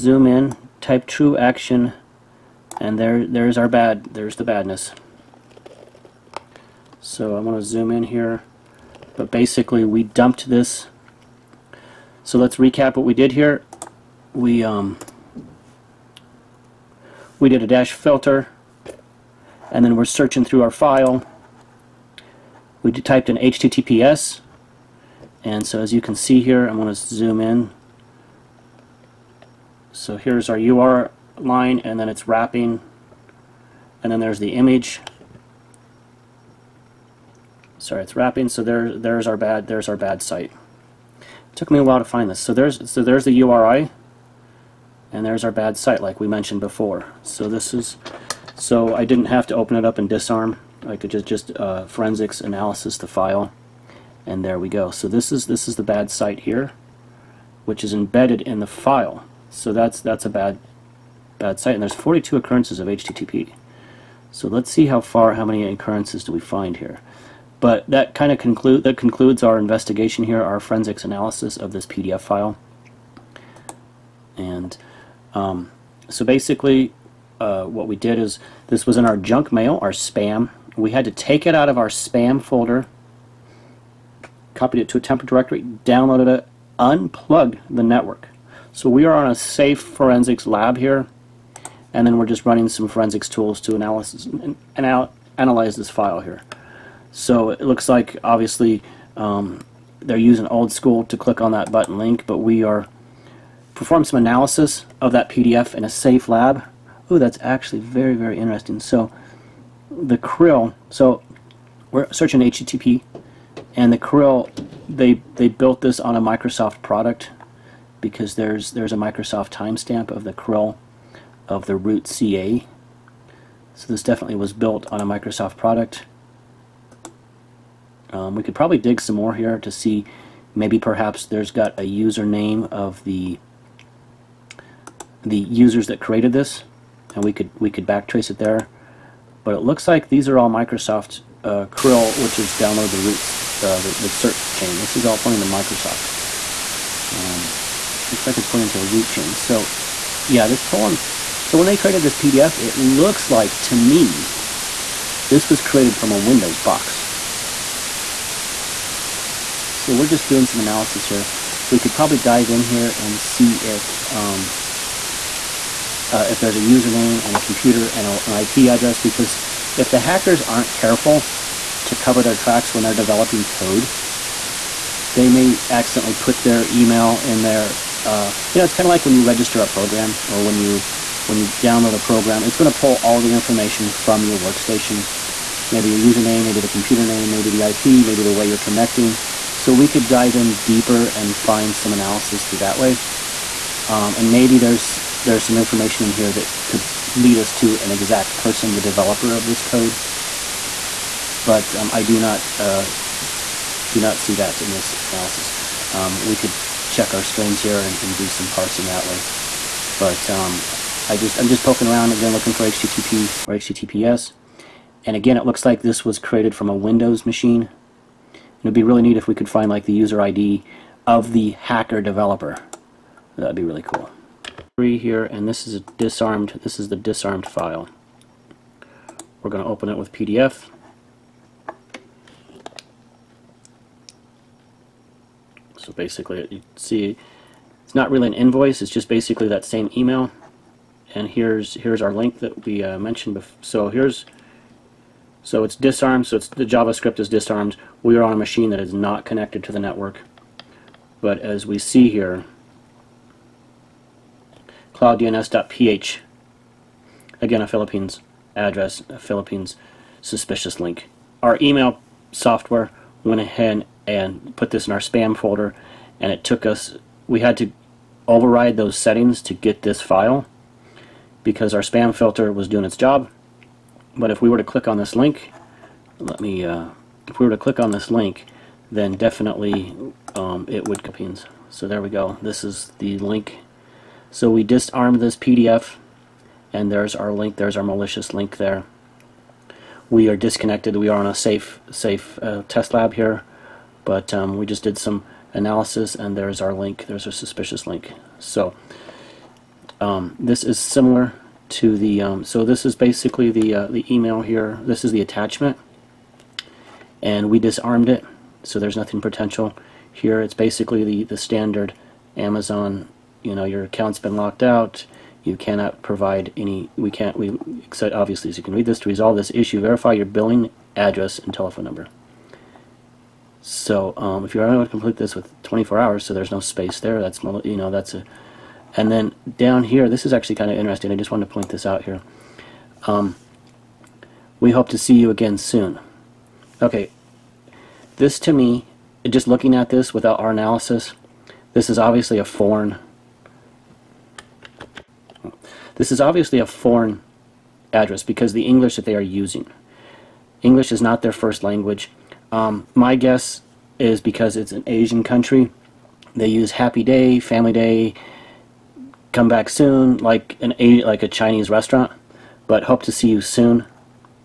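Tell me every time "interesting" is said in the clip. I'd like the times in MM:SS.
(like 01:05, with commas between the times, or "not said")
01:48, 05:30.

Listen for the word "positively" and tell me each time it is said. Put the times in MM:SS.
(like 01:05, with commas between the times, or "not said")
not said.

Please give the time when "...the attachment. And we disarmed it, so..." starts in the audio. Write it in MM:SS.
05:05.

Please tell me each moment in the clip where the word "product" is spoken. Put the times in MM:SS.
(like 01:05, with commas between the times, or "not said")
01:56, 02:05.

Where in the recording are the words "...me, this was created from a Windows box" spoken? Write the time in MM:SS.
02:33.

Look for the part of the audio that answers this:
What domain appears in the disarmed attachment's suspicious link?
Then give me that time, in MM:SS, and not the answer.
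04:14.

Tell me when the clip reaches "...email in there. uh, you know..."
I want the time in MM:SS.
02:56.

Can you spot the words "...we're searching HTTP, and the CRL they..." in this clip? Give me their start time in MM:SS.
01:51.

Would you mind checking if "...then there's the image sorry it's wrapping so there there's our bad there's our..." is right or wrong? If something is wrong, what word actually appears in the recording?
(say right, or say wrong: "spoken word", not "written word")
right.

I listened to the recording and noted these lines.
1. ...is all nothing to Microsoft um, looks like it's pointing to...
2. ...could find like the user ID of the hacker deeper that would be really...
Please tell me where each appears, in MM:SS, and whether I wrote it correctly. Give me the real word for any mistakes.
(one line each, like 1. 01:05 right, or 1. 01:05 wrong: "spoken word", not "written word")
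1. 02:24 wrong: "pointing", not "nothing"
2. 03:39 wrong: "developer", not "deeper".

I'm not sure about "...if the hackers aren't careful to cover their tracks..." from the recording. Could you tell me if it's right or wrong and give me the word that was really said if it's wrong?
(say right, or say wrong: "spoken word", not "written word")
right.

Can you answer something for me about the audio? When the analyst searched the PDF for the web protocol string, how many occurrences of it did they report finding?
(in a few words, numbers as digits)
42.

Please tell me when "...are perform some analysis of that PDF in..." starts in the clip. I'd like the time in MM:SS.
01:42.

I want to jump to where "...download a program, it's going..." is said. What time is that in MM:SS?
03:01.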